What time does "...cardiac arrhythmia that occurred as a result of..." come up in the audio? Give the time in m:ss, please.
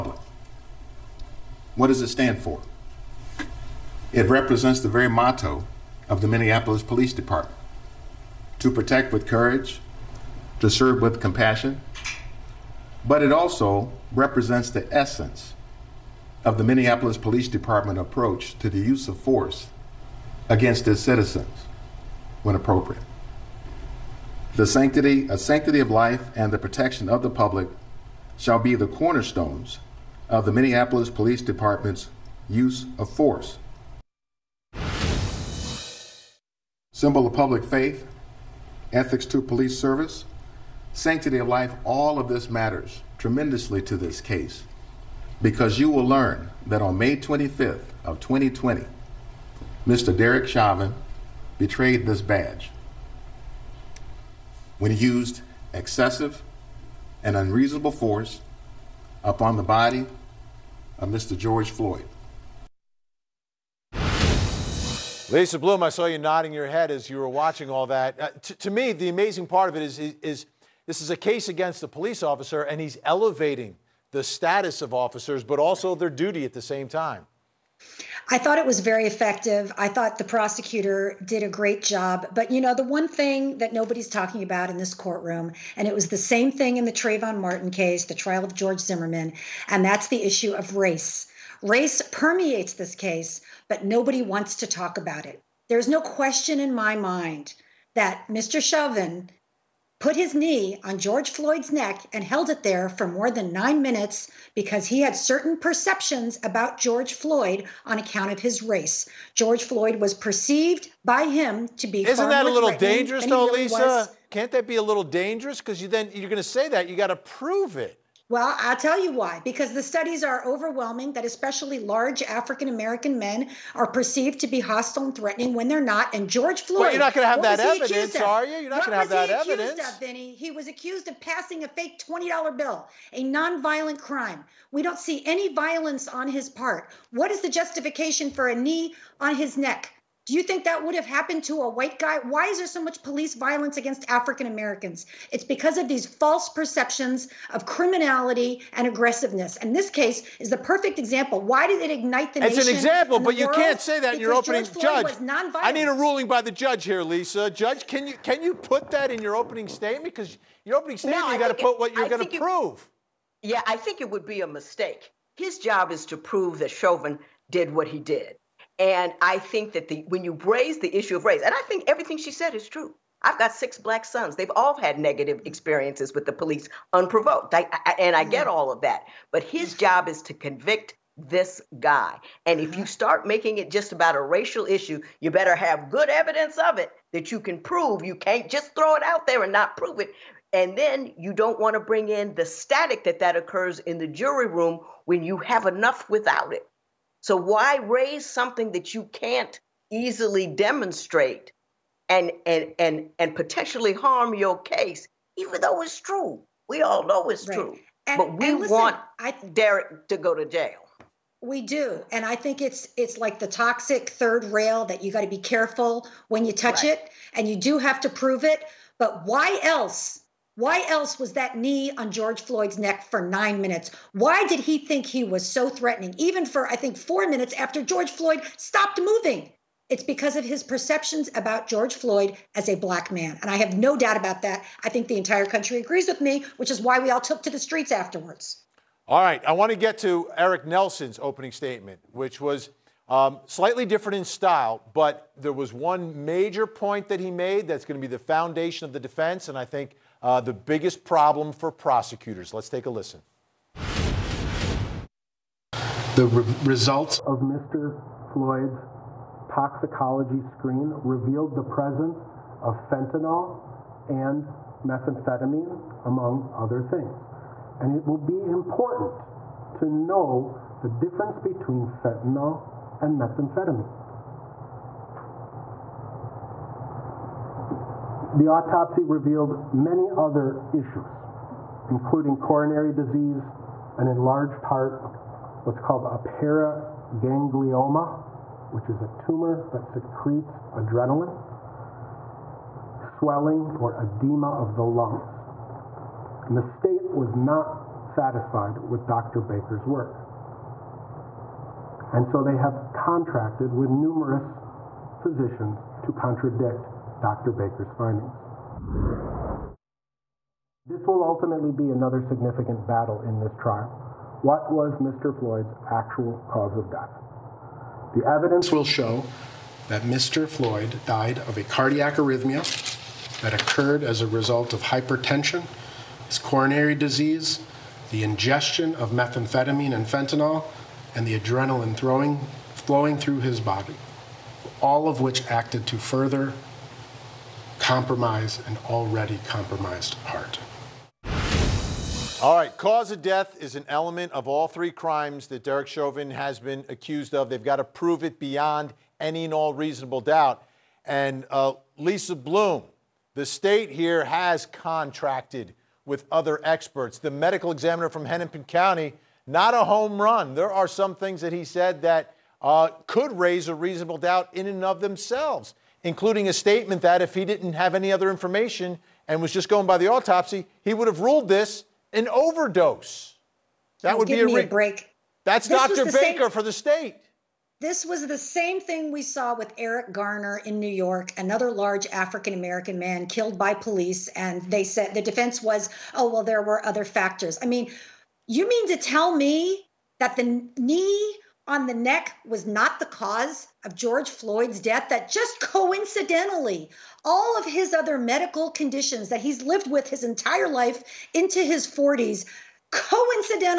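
5:21.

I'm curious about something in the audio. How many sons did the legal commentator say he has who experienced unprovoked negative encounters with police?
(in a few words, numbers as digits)
6.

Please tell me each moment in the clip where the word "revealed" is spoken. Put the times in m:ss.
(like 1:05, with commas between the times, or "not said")
4:21, 4:39.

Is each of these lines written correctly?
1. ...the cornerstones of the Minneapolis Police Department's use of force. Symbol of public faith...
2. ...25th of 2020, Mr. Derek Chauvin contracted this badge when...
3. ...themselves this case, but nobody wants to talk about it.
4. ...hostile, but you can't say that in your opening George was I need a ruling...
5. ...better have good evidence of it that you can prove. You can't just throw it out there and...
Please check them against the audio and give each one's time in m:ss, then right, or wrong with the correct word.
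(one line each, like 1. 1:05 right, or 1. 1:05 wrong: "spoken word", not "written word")
1. 0:28 right
2. 0:47 wrong: "betrayed", not "contracted"
3. 1:32 wrong: "permeates", not "themselves"
4. 2:32 wrong: "example", not "hostile"
5. 3:05 right.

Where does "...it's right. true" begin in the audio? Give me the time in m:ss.
3:27.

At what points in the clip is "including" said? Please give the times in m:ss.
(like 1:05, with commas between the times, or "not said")
4:41, 6:06.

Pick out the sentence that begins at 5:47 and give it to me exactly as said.
They've got to prove it beyond any and all reasonable doubt.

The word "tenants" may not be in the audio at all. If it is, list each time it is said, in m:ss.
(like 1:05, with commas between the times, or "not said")
not said.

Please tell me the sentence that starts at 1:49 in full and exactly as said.
George Floyd was perceived by him to be.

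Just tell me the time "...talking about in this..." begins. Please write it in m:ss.
1:24.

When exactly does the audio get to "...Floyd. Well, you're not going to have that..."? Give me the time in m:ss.
2:06.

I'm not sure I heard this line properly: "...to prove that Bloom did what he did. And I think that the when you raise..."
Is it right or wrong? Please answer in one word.
wrong.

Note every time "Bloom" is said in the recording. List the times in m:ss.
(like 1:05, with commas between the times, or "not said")
1:05, 5:52.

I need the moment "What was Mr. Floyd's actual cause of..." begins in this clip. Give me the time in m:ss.
5:14.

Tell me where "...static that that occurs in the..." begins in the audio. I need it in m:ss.
3:12.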